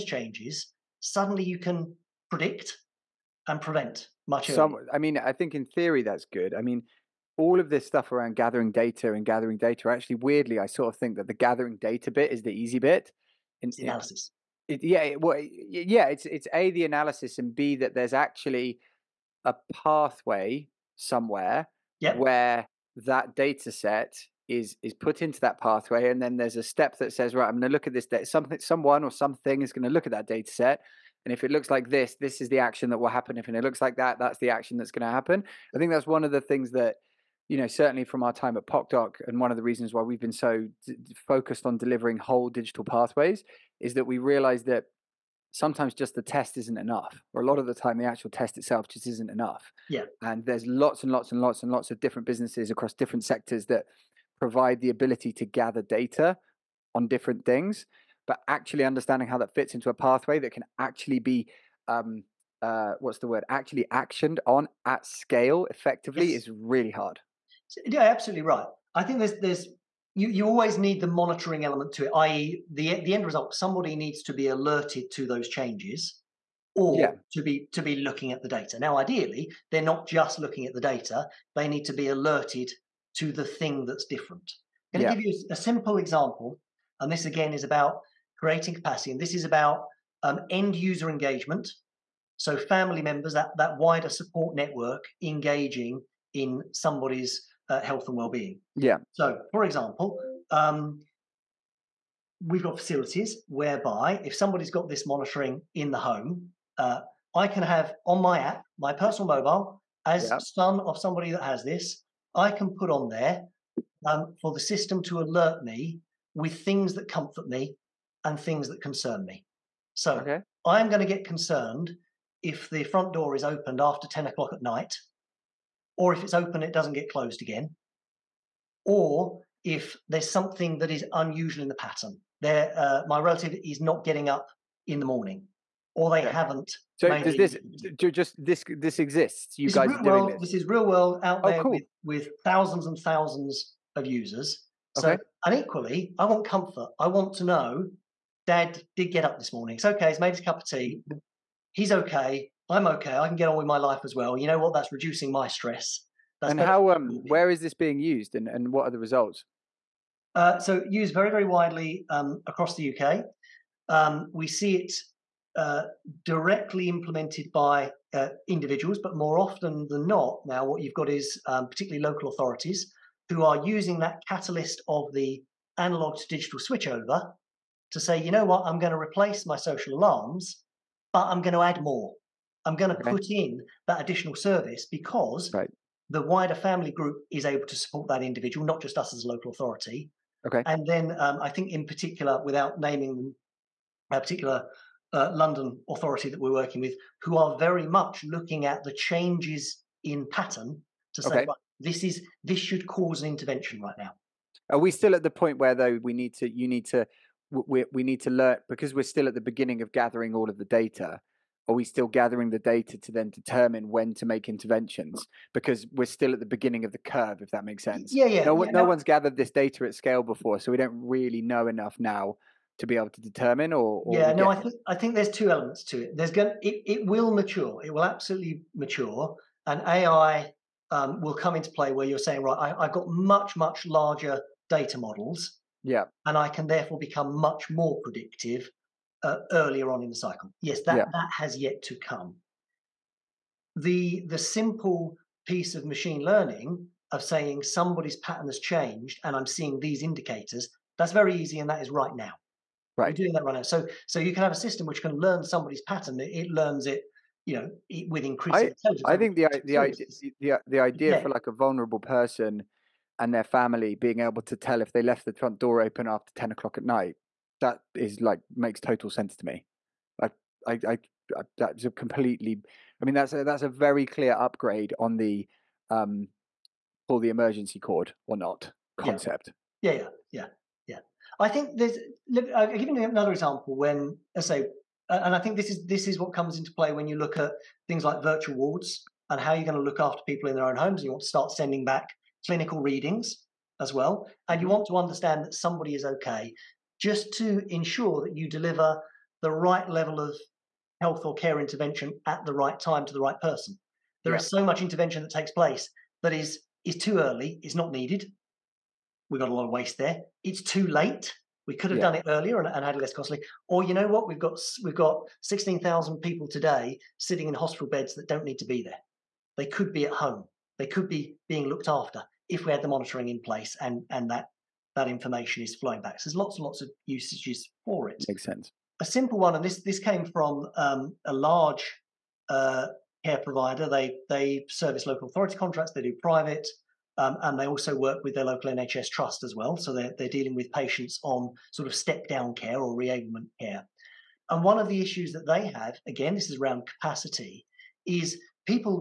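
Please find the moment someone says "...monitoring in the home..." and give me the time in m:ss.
1:45.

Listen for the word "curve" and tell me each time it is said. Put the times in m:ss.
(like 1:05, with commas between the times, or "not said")
3:36.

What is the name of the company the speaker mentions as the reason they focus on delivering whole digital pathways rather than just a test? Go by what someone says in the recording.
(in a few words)
PocDoc.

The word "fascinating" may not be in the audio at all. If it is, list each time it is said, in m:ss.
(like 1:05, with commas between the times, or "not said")
not said.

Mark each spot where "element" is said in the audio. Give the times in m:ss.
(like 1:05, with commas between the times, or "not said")
1:11, 3:45.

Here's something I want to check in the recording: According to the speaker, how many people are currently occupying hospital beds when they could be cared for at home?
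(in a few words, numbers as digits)
16,000.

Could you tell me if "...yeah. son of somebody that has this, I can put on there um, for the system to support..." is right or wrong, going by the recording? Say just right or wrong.
wrong.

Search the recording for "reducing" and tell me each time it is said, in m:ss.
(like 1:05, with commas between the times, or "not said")
2:34.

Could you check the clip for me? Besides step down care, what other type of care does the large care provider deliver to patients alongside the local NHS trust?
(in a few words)
reablement care.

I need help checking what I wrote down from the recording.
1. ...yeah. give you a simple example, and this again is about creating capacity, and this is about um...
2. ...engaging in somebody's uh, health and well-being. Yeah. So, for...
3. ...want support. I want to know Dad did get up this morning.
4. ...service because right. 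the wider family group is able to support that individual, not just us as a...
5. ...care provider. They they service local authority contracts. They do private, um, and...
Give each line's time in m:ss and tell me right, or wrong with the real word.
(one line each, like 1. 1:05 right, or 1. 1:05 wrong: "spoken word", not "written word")
1. 1:25 right
2. 1:35 right
3. 2:26 wrong: "comfort", not "support"
4. 3:04 right
5. 5:33 right.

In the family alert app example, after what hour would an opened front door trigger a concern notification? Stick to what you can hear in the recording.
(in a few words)
10 o'clock at night.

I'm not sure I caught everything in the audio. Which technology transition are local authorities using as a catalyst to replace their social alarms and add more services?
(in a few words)
analog to digital switchover.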